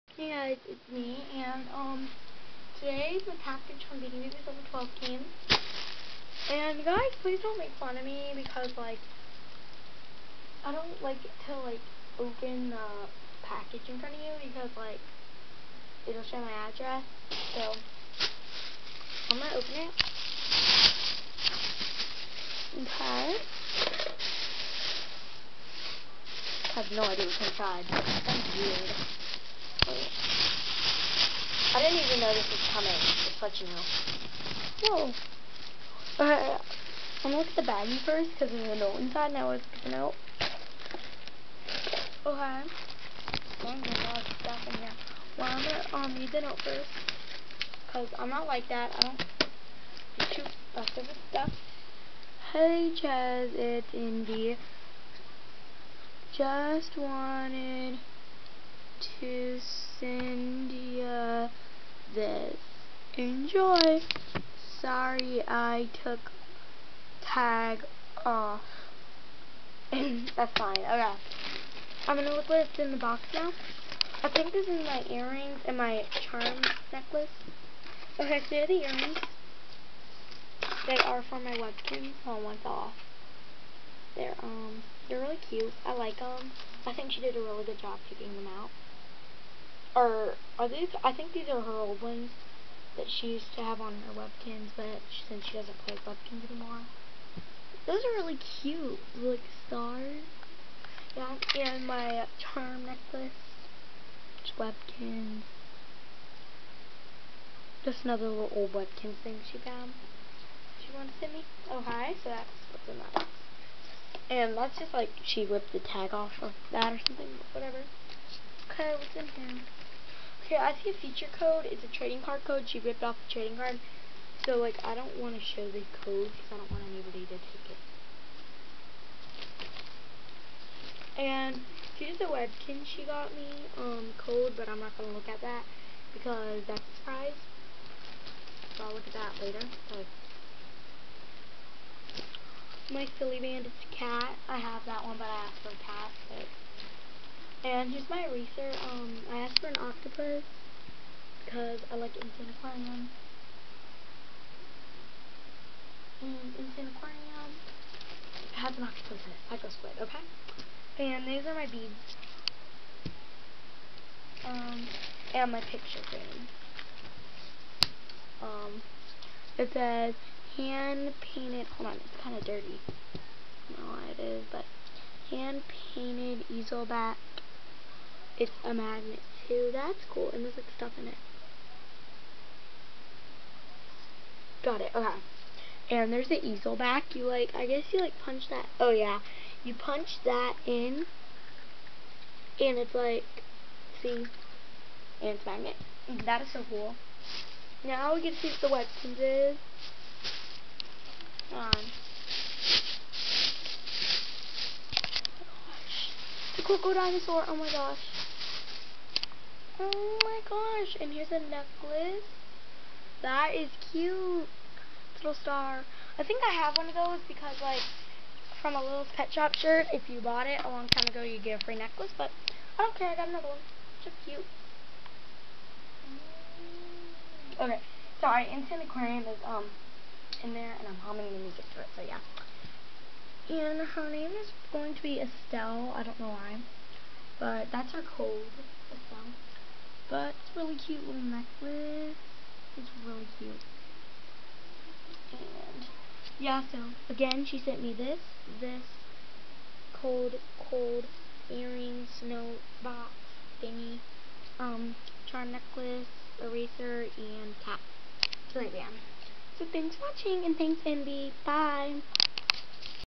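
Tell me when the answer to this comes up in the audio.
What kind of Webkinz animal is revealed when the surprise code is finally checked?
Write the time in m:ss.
3:26.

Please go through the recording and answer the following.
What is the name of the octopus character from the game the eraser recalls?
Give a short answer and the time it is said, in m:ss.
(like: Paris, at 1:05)
Psycho Squid, at 2:39.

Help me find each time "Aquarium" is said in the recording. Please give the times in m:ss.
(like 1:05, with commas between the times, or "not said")
2:32, 2:36.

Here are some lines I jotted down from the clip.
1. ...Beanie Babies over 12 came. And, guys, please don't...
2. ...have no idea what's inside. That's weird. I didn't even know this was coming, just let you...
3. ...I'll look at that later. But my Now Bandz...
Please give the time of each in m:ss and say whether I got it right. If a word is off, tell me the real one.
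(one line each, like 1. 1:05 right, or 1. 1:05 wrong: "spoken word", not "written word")
1. 0:04 right
2. 0:26 right
3. 2:18 wrong: "Silly", not "Now".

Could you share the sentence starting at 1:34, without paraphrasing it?
but she, since she doesn't play Webkinz anymore.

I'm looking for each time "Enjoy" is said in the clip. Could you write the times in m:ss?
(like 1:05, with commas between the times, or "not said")
1:03.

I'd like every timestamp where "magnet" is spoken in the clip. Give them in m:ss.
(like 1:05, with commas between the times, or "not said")
2:58, 3:15.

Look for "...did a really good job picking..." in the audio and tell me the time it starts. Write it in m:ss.
1:27.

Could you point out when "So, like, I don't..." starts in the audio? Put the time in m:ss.
2:04.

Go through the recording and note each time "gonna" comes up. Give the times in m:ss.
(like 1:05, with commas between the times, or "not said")
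0:19, 0:37, 0:45.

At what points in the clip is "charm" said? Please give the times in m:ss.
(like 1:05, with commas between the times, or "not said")
1:16, 1:42, 4:15.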